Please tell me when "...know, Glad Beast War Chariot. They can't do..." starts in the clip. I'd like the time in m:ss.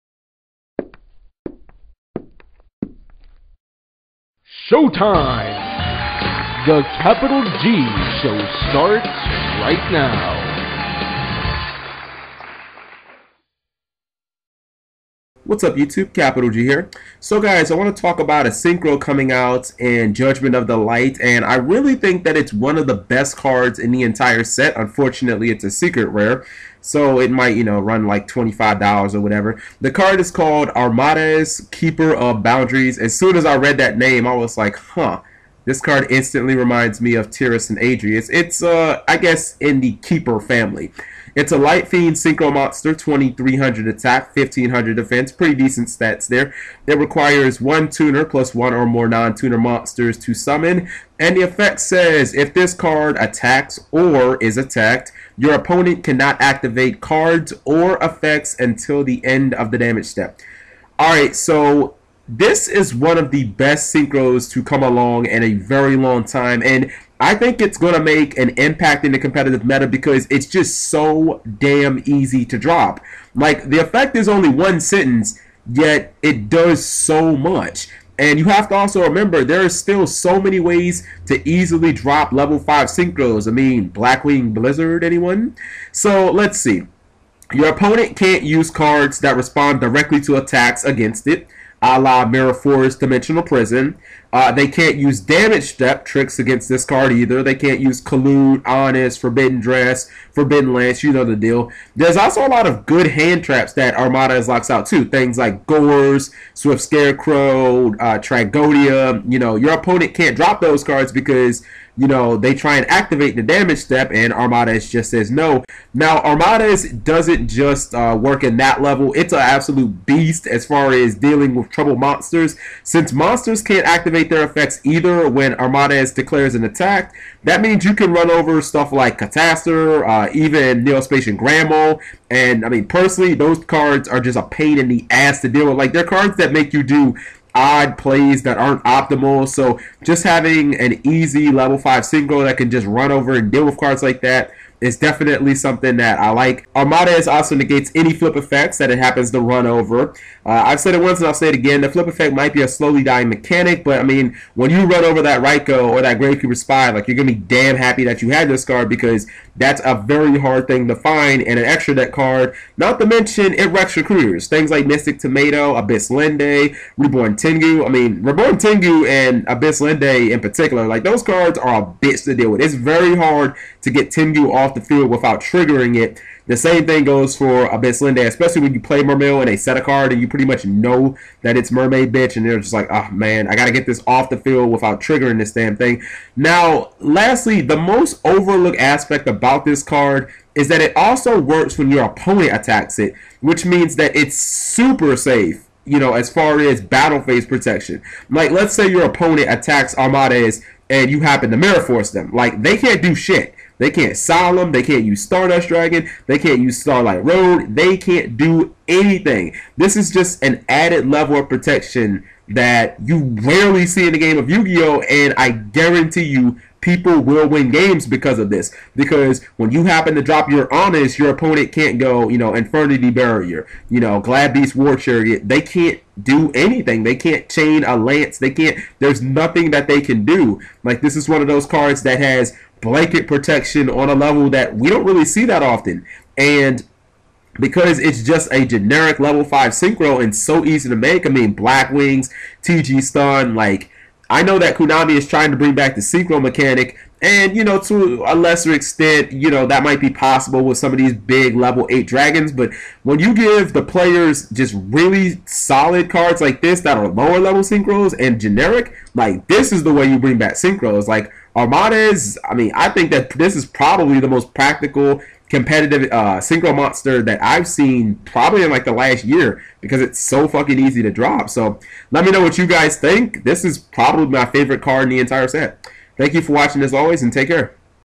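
3:43.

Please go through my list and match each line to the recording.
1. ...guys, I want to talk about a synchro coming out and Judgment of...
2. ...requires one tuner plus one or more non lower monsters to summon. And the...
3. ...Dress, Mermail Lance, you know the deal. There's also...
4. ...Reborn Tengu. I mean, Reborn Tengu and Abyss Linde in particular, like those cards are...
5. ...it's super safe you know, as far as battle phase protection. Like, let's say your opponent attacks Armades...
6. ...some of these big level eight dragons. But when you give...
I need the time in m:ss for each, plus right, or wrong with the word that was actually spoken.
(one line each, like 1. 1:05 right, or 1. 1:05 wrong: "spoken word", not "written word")
1. 0:17 right
2. 0:46 wrong: "tuner", not "lower"
3. 1:39 wrong: "Forbidden", not "Mermail"
4. 2:46 right
5. 3:14 right
6. 4:10 right.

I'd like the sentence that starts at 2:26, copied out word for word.
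Armada is also negates any flip effects that it happens to run over.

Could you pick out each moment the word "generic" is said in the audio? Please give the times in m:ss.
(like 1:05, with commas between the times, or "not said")
3:58, 4:18.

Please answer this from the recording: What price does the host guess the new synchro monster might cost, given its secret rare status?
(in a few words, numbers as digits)
$25.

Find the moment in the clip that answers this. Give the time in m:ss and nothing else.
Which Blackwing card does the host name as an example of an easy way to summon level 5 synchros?
1:23.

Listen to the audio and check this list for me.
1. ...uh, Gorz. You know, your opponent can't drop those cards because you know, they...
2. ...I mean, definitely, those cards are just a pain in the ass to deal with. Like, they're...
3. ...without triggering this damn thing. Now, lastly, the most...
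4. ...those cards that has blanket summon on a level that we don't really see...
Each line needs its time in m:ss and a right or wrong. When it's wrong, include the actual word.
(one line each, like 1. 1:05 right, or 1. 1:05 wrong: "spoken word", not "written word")
1. 1:47 wrong: "Tragoedia", not "Gorz"
2. 2:12 wrong: "personally", not "definitely"
3. 3:04 right
4. 3:51 wrong: "protection", not "summon".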